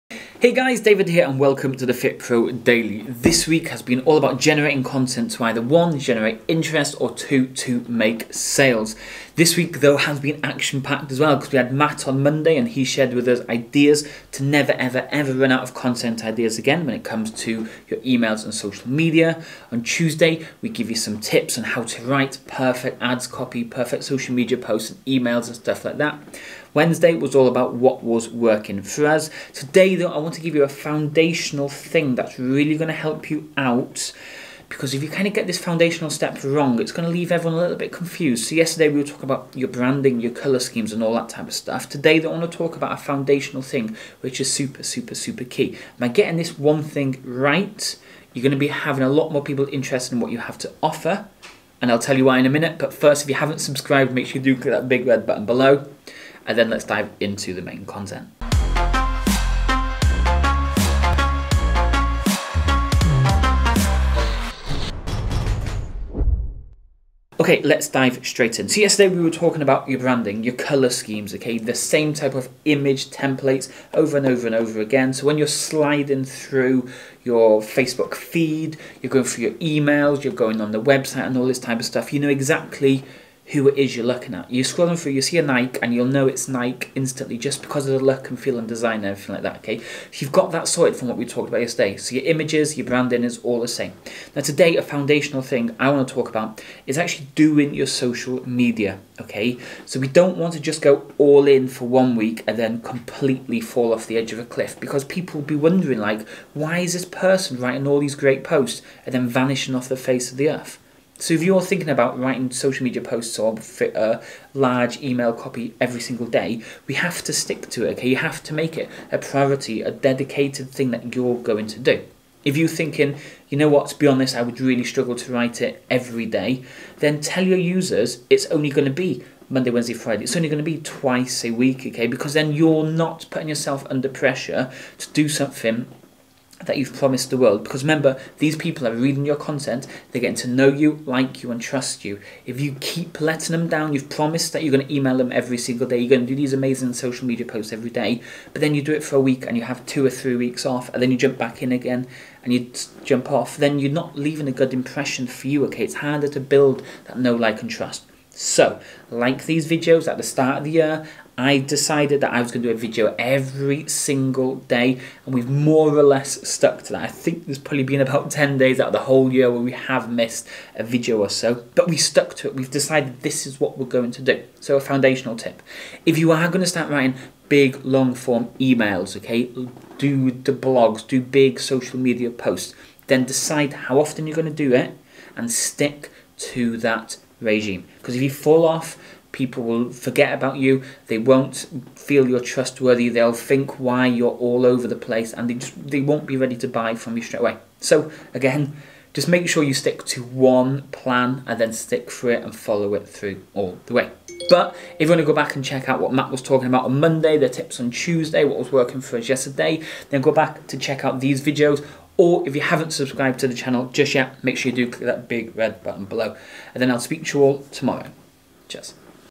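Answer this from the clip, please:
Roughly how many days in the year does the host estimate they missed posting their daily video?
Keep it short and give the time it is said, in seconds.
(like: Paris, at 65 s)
10, at 168 s.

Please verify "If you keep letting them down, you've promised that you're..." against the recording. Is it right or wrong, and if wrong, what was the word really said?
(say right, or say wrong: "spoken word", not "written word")
right.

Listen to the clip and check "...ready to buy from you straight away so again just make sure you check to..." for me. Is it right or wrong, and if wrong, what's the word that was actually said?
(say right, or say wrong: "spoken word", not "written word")
wrong: "stick", not "check".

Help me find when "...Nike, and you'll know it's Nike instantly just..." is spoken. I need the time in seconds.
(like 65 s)
85 s.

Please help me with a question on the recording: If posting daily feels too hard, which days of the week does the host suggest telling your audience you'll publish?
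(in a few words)
Monday, Wednesday, Friday.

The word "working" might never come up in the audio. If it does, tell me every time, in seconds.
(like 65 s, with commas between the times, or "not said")
28 s, 208 s.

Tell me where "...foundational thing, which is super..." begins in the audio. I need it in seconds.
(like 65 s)
42 s.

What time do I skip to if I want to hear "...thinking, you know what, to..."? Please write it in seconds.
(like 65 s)
122 s.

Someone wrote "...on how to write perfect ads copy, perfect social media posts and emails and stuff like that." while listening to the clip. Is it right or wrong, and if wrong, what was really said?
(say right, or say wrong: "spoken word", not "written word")
right.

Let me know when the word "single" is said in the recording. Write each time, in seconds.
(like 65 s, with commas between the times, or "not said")
116 s, 145 s, 163 s.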